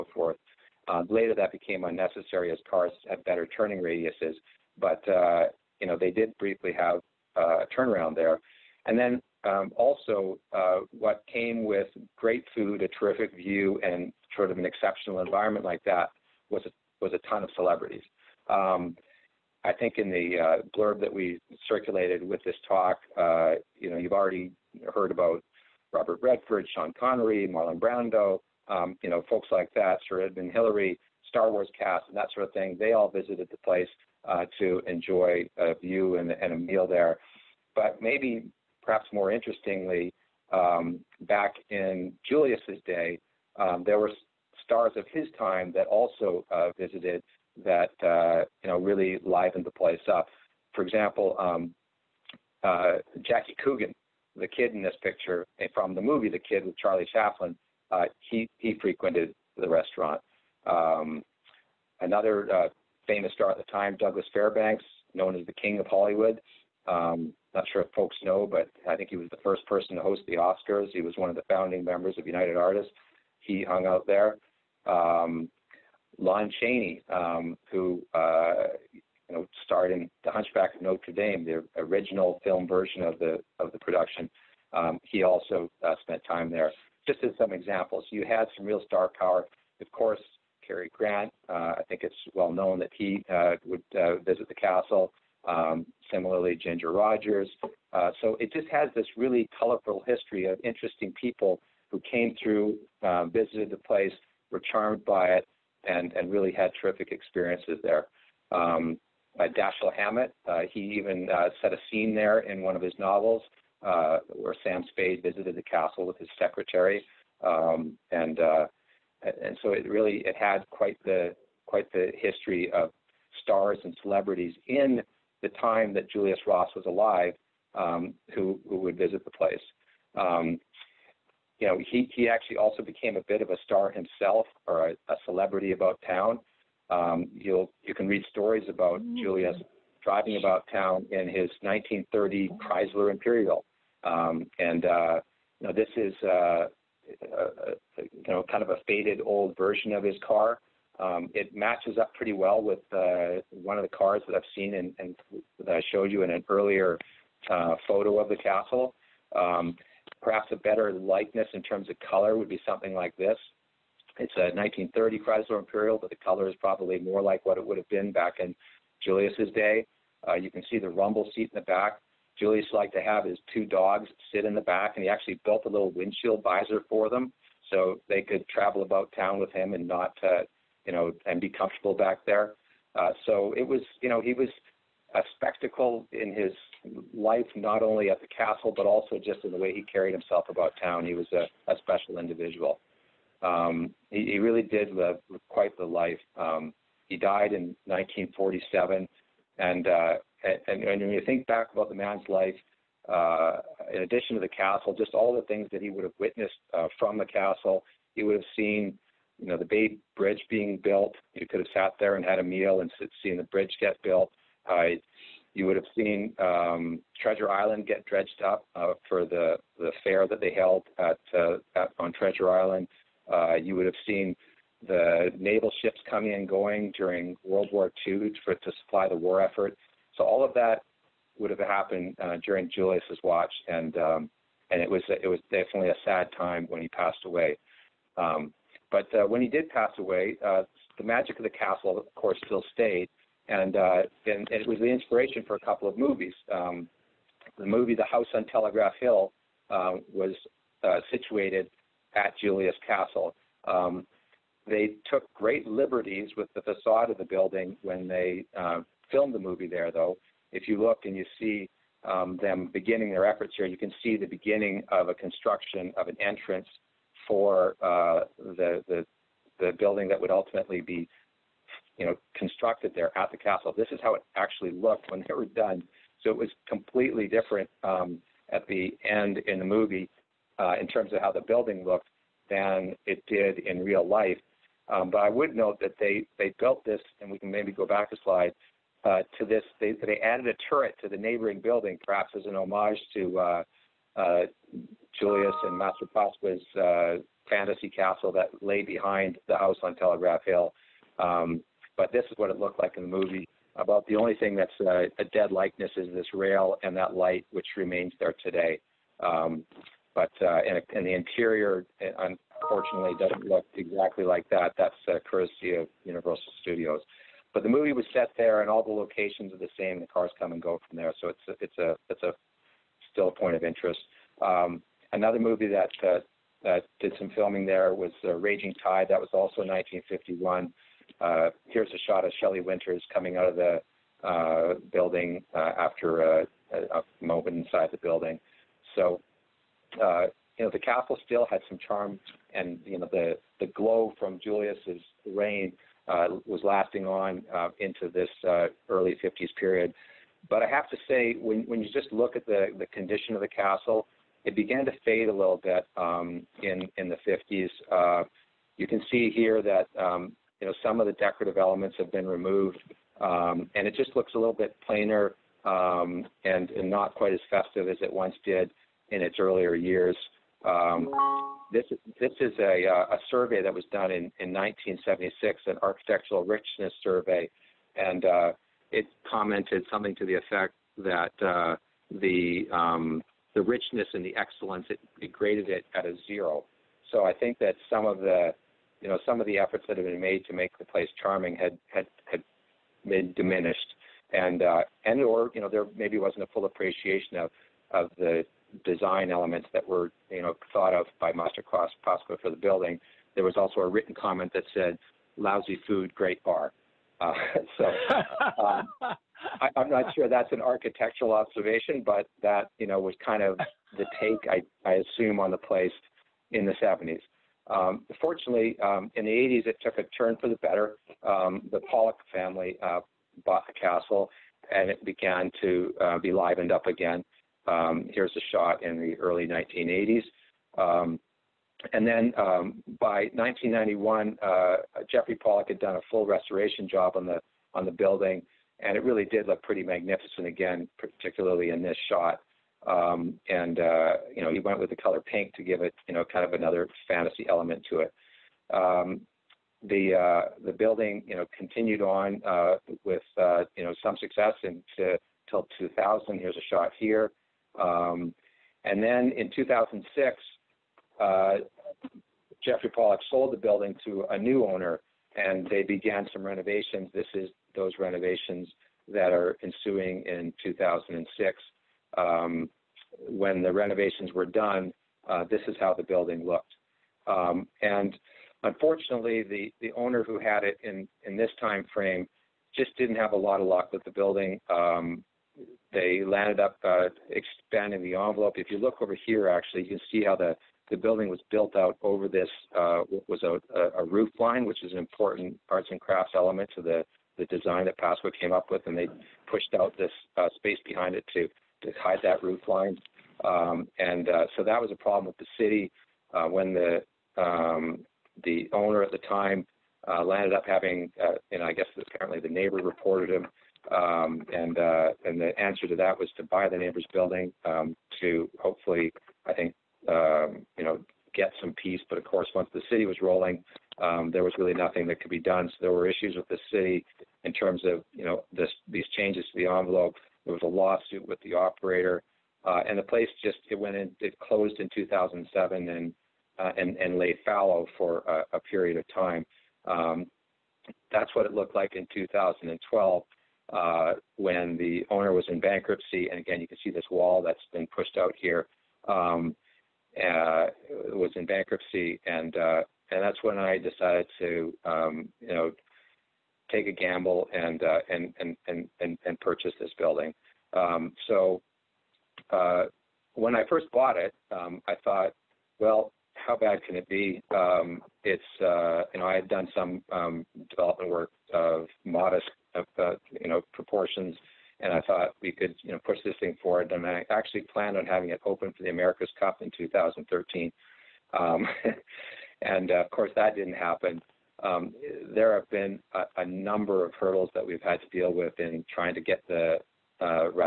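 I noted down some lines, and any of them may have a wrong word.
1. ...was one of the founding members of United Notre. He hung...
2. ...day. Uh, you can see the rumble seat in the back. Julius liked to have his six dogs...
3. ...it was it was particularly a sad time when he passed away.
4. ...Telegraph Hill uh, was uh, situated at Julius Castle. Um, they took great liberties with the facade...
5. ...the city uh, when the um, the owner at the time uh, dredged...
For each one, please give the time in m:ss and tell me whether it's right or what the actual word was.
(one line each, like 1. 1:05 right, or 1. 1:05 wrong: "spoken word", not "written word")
1. 1:11 wrong: "Artists", not "Notre"
2. 2:49 wrong: "two", not "six"
3. 3:54 wrong: "definitely", not "particularly"
4. 4:08 right
5. 8:25 wrong: "landed", not "dredged".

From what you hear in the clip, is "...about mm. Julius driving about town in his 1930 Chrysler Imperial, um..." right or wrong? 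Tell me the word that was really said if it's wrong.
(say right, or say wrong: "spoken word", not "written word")
right.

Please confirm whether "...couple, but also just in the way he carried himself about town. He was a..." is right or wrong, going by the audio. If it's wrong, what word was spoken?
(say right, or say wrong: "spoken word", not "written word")
wrong: "castle", not "couple".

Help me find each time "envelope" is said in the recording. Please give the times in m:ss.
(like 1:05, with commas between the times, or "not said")
8:08, 8:49.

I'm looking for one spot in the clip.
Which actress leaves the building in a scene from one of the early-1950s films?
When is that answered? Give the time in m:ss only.
5:32.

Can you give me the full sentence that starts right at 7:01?
Um, the Pollock family uh, bought the castle, and it began to uh, be livened up again.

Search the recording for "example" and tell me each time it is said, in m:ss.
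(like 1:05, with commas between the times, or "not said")
0:50, 1:27.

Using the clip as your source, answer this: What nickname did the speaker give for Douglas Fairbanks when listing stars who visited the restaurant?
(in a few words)
King of Hollywood.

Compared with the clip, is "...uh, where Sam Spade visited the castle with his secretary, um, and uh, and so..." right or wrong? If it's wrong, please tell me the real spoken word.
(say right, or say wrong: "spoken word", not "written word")
right.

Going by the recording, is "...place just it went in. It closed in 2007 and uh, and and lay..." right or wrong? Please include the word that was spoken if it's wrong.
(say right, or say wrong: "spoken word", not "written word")
right.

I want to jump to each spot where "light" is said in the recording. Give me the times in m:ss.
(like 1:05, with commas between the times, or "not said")
5:07.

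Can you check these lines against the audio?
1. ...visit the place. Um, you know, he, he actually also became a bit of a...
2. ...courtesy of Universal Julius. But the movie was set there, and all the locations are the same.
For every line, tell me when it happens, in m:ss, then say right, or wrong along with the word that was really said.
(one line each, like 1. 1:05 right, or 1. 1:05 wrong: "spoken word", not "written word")
1. 2:08 right
2. 5:15 wrong: "Studios", not "Julius".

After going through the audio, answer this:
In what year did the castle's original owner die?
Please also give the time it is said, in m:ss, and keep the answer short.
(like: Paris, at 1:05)
1947, at 3:17.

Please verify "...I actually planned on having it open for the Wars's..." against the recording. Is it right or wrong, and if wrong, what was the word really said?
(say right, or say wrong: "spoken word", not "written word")
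wrong: "America", not "Wars".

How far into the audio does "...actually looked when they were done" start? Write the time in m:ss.
4:34.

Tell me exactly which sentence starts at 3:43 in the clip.
Uh, you would have seen the naval ships coming and going during World War II for, to supply the war effort.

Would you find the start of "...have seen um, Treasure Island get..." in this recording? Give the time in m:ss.
3:35.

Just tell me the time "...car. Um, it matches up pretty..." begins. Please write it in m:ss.
2:30.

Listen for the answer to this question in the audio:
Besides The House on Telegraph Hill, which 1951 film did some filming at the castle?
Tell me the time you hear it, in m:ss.
5:28.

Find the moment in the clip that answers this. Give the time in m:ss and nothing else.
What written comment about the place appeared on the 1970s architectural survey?
6:45.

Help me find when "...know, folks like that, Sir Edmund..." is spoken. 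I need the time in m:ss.
0:29.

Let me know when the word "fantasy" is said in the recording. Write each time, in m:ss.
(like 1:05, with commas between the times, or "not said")
4:57, 7:27.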